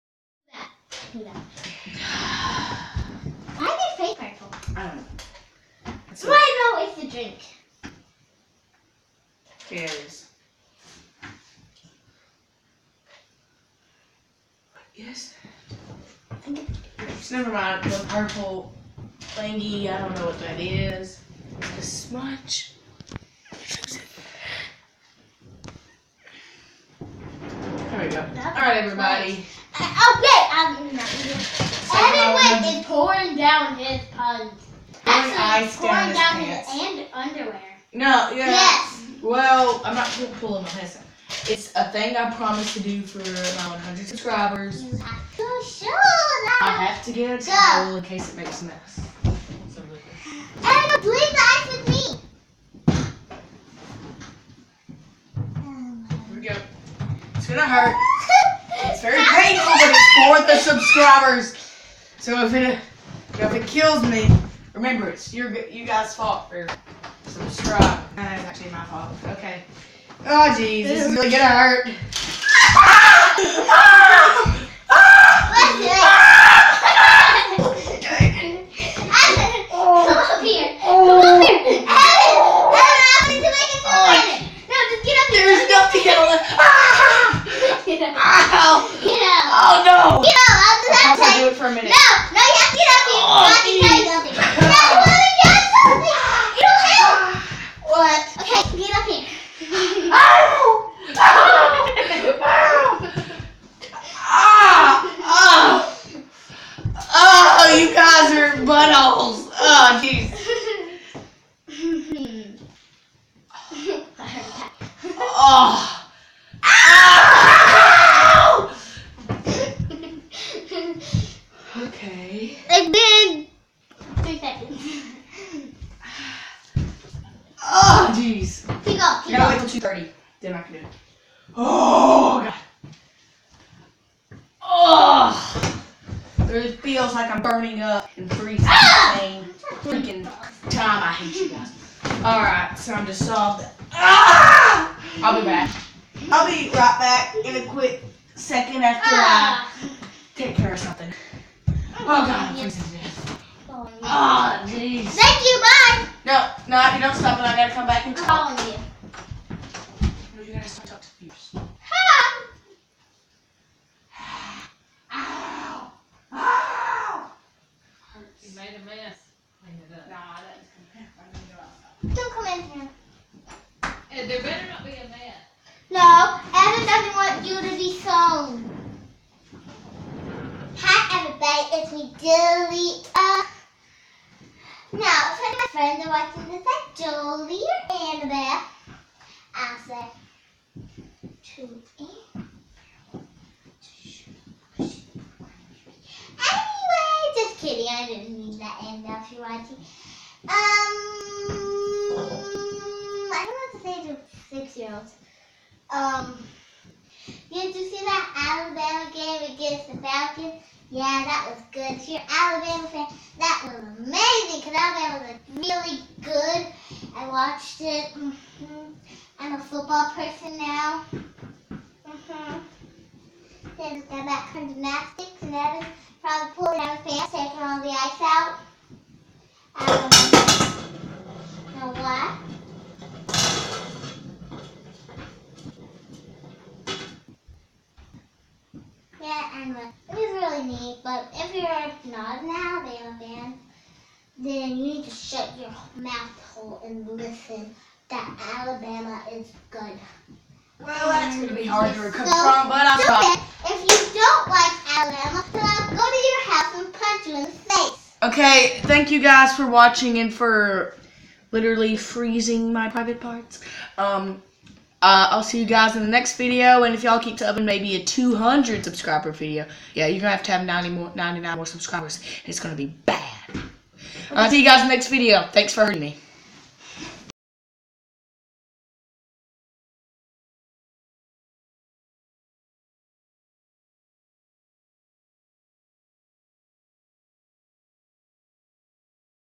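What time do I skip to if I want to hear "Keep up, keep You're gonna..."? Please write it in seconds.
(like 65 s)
128 s.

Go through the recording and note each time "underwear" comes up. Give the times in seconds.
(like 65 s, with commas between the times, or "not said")
37 s.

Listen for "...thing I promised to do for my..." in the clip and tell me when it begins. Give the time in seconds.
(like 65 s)
41 s.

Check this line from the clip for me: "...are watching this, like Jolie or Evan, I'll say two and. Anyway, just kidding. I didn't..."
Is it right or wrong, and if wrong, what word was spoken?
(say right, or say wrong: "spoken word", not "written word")
wrong: "Annabelle", not "Evan".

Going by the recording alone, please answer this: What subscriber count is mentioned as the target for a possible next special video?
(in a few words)
200.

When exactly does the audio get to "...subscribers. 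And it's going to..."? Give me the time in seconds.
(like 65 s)
271 s.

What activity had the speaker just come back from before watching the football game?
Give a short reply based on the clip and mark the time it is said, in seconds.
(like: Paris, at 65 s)
gymnastics, at 224 s.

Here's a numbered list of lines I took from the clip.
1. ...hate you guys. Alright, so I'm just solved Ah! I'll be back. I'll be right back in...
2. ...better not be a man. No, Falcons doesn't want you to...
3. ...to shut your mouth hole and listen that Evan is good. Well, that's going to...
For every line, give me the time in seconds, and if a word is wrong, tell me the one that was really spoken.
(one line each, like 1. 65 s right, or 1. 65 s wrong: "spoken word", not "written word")
1. 141 s right
2. 174 s wrong: "Evan", not "Falcons"
3. 245 s wrong: "Alabama", not "Evan".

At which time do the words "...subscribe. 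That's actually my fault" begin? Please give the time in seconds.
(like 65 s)
67 s.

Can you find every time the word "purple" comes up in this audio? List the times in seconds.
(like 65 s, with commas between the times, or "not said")
4 s, 18 s.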